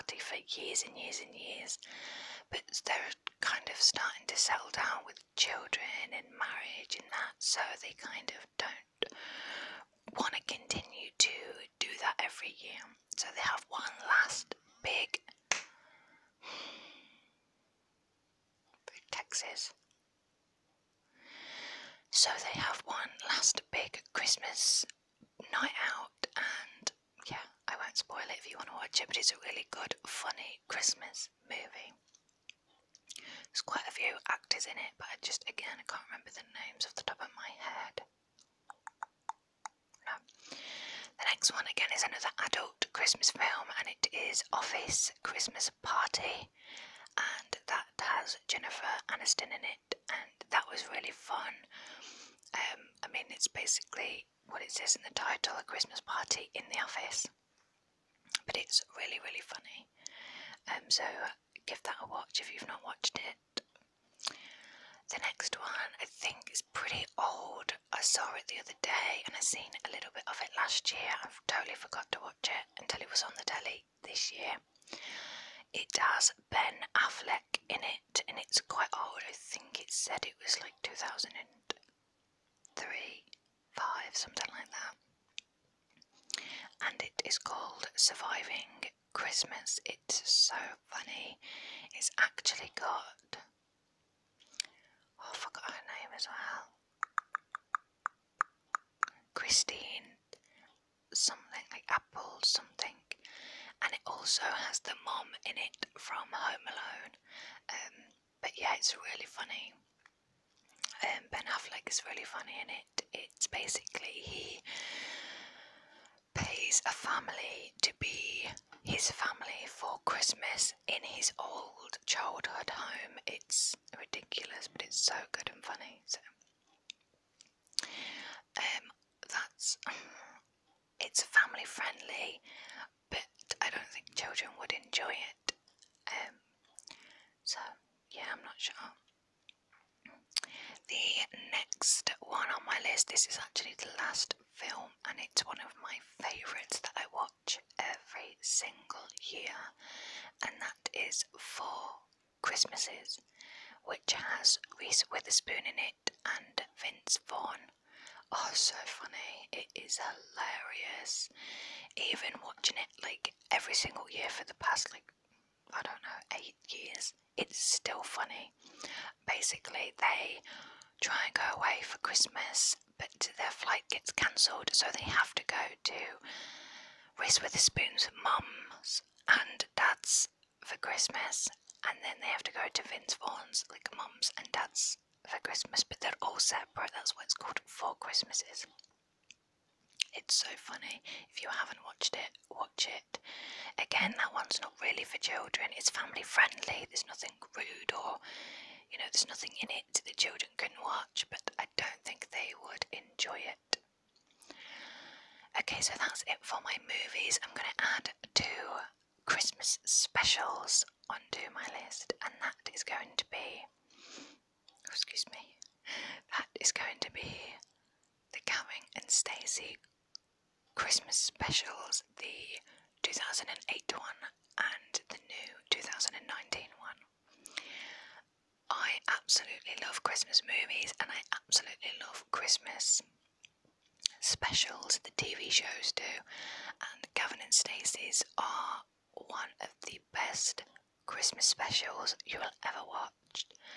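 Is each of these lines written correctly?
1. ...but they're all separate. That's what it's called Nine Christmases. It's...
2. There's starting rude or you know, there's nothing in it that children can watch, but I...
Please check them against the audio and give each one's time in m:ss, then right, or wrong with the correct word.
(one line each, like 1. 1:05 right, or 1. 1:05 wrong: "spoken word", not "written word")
1. 3:05 wrong: "Four", not "Nine"
2. 3:16 wrong: "nothing", not "starting".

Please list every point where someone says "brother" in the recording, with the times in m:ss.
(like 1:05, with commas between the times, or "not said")
not said.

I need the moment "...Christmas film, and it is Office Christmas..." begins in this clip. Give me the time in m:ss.
0:42.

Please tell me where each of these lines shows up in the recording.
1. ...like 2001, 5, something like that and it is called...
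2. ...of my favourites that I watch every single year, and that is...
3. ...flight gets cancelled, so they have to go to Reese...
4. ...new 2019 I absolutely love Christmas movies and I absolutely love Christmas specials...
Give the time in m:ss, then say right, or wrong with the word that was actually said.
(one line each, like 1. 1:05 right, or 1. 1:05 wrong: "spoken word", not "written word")
1. 1:20 wrong: "2003", not "2001"
2. 2:25 right
3. 2:53 right
4. 3:45 right.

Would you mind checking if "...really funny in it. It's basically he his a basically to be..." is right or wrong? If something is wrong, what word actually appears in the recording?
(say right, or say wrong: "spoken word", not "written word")
wrong: "family", not "basically".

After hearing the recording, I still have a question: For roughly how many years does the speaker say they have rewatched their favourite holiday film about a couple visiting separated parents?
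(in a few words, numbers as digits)
8.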